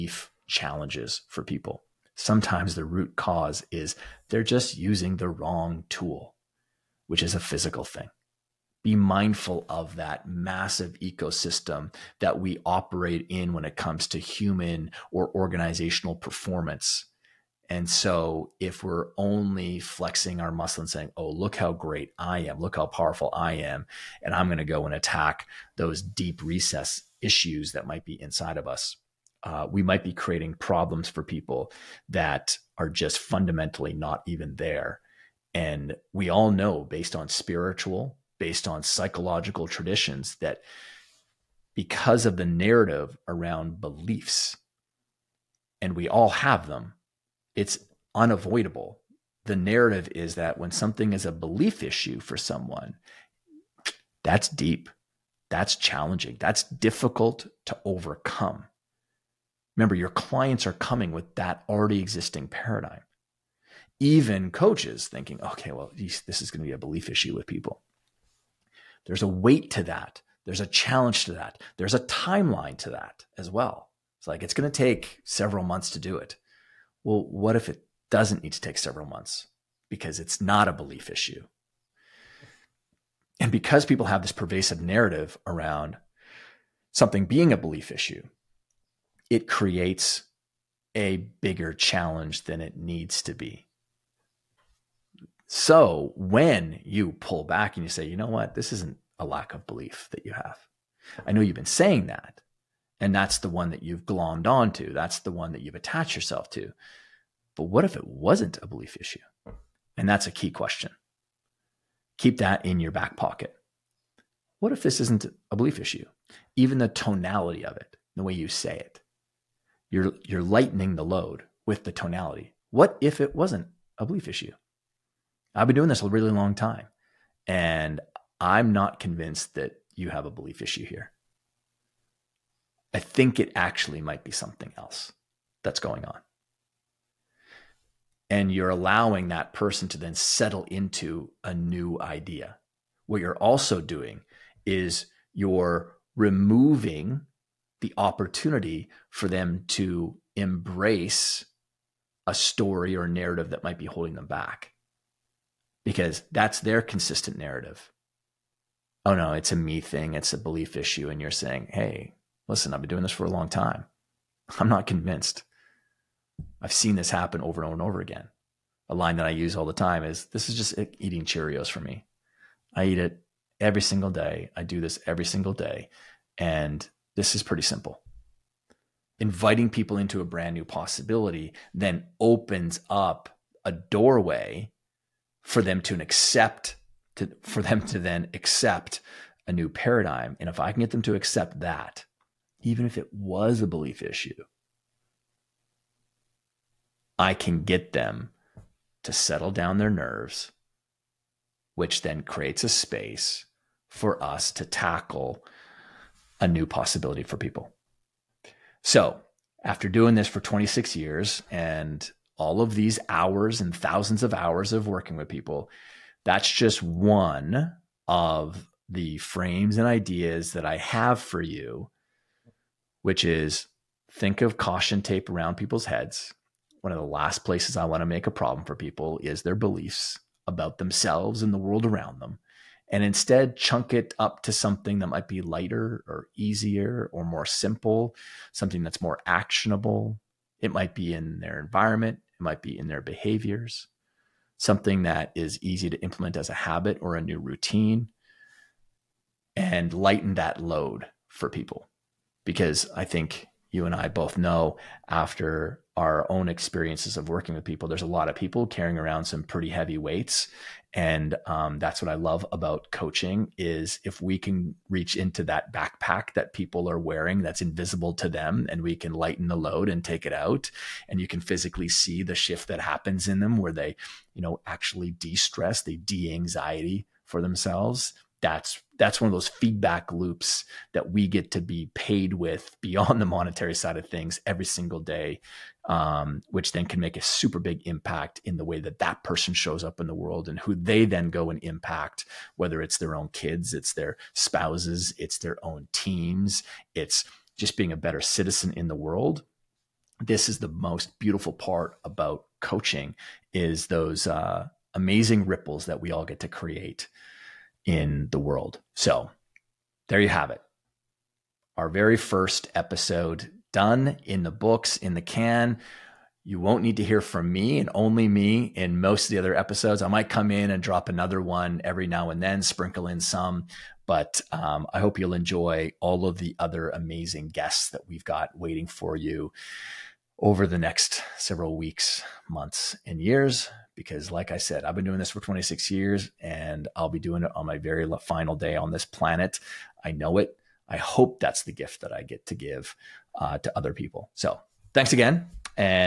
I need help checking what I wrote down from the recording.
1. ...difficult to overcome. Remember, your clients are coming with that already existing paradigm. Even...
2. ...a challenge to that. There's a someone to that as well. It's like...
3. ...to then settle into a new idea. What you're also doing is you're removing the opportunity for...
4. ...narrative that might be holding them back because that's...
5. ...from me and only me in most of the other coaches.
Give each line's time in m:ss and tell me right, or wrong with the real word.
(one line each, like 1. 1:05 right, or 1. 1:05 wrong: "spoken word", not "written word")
1. 0:56 right
2. 1:10 wrong: "timeline", not "someone"
3. 2:19 right
4. 2:33 right
5. 5:17 wrong: "episodes", not "coaches".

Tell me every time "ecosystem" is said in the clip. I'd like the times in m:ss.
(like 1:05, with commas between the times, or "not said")
0:10.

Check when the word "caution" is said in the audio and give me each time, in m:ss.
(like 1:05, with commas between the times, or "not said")
3:44.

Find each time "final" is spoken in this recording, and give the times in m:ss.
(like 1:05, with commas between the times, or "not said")
5:38.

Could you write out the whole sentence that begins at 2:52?
I eat it every single day.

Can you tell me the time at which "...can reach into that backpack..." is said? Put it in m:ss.
4:24.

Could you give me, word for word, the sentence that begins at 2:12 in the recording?
I think it actually might be something else that's going on.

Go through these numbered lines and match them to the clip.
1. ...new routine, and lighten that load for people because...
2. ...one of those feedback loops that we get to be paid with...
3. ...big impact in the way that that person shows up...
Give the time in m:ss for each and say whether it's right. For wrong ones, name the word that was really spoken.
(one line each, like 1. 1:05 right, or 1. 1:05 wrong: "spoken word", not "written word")
1. 4:07 right
2. 4:39 right
3. 4:47 right.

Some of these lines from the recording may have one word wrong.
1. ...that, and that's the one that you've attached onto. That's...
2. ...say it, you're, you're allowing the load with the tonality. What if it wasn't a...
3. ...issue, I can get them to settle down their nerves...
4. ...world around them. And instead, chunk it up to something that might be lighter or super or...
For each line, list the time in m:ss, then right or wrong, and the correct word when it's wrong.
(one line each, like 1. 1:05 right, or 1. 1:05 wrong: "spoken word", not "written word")
1. 1:42 wrong: "glommed", not "attached"
2. 1:58 wrong: "lightening", not "allowing"
3. 3:14 right
4. 3:51 wrong: "easier", not "super".